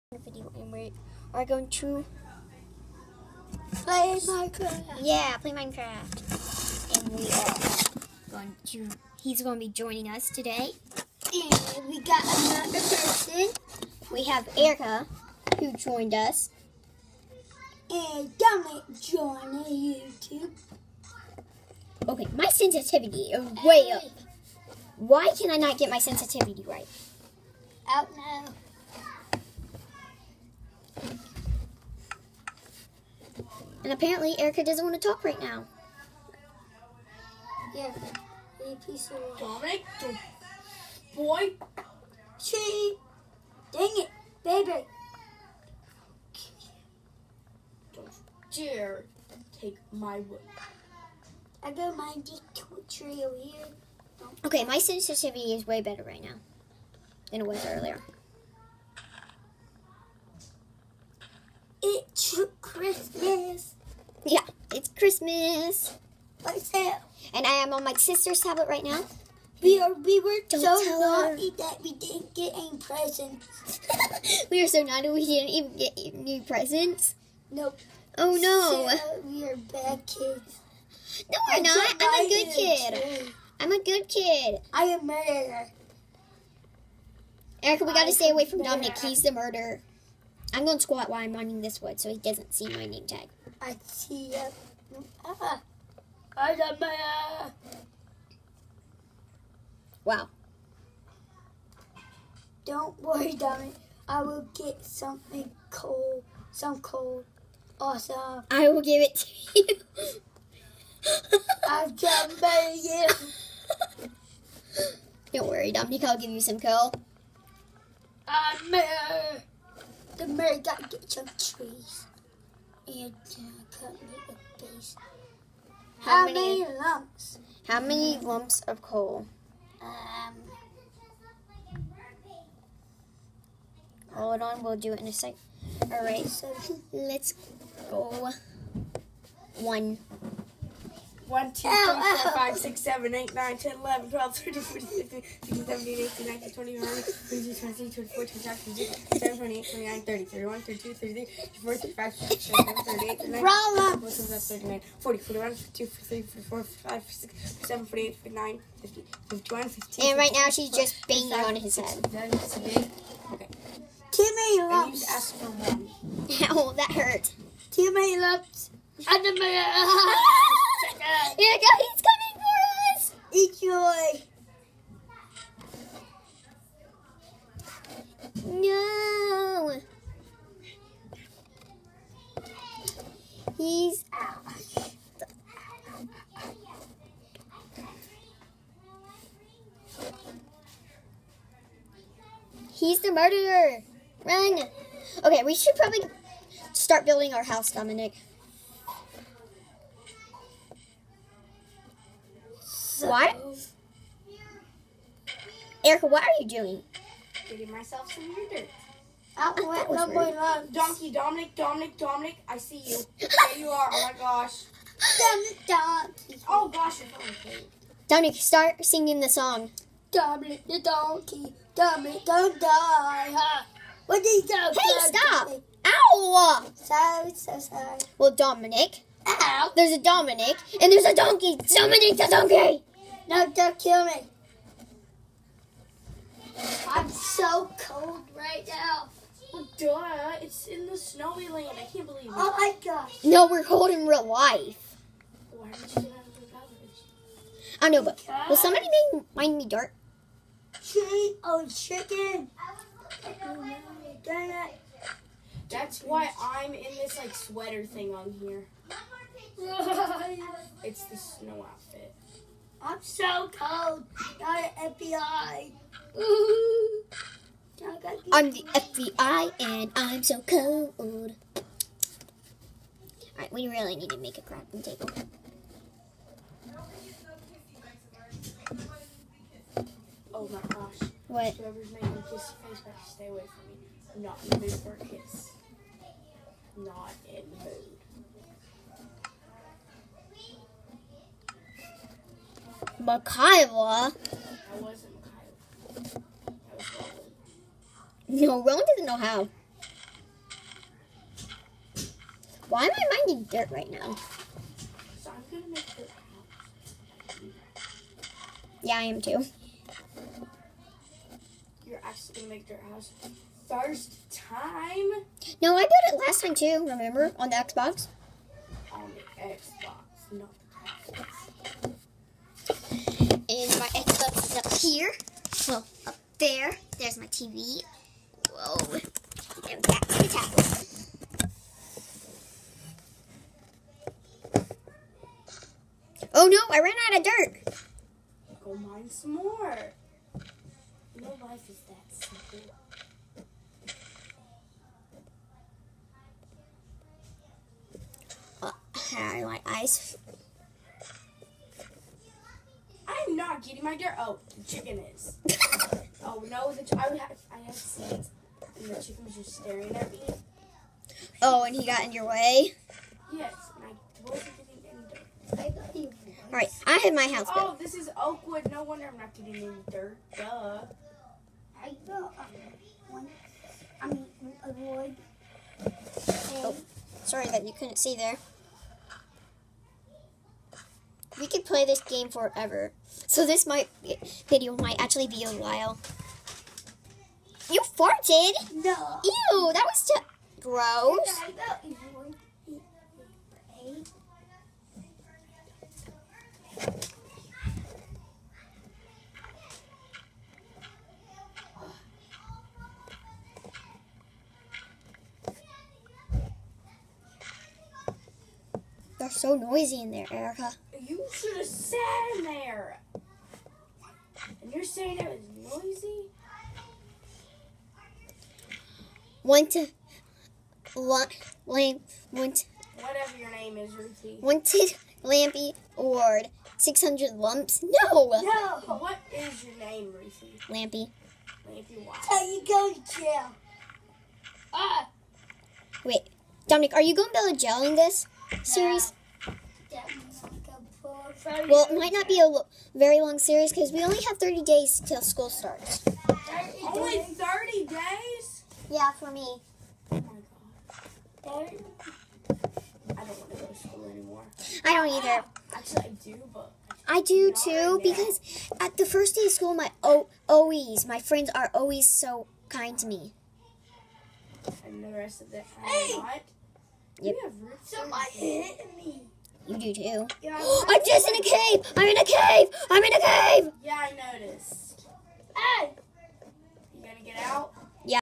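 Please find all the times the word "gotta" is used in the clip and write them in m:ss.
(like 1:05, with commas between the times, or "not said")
1:27, 2:00.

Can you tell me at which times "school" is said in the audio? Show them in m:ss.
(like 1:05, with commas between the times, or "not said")
7:25, 7:33, 7:39.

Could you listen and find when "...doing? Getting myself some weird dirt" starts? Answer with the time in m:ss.
3:26.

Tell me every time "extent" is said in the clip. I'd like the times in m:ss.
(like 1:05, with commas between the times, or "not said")
not said.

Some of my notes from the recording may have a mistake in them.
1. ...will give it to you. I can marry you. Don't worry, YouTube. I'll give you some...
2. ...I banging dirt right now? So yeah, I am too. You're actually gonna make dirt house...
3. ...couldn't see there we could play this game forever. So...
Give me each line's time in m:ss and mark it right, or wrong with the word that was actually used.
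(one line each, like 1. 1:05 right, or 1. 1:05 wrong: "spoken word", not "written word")
1. 1:48 wrong: "Dominic", not "YouTube"
2. 5:02 wrong: "mining", not "banging"
3. 6:17 right.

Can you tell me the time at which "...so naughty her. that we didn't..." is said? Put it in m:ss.
1:10.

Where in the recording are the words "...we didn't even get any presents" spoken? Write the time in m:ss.
1:15.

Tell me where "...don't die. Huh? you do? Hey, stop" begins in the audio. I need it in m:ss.
3:42.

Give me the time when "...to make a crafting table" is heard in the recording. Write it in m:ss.
4:34.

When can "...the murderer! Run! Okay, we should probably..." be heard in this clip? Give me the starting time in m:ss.
3:12.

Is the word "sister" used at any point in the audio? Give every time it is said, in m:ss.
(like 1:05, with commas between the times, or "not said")
1:07.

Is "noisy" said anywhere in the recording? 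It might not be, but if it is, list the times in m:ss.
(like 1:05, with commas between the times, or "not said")
6:49, 6:55.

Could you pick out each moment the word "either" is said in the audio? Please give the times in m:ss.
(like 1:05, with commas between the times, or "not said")
7:35.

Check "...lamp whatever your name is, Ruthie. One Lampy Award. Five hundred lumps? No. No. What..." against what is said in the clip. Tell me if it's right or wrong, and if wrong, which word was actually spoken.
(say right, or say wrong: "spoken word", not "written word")
wrong: "Six", not "Five".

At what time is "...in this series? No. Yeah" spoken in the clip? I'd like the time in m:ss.
7:17.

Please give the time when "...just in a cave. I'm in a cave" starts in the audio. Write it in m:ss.
7:51.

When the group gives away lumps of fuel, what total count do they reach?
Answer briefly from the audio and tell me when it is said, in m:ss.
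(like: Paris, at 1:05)
52, at 2:39.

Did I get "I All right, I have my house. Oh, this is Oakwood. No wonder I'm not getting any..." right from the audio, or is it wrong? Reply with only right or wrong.
right.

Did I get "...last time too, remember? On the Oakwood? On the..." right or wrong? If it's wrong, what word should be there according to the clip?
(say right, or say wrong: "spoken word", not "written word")
wrong: "Xbox", not "Oakwood".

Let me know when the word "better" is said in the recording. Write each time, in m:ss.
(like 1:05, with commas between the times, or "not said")
0:55, 4:42.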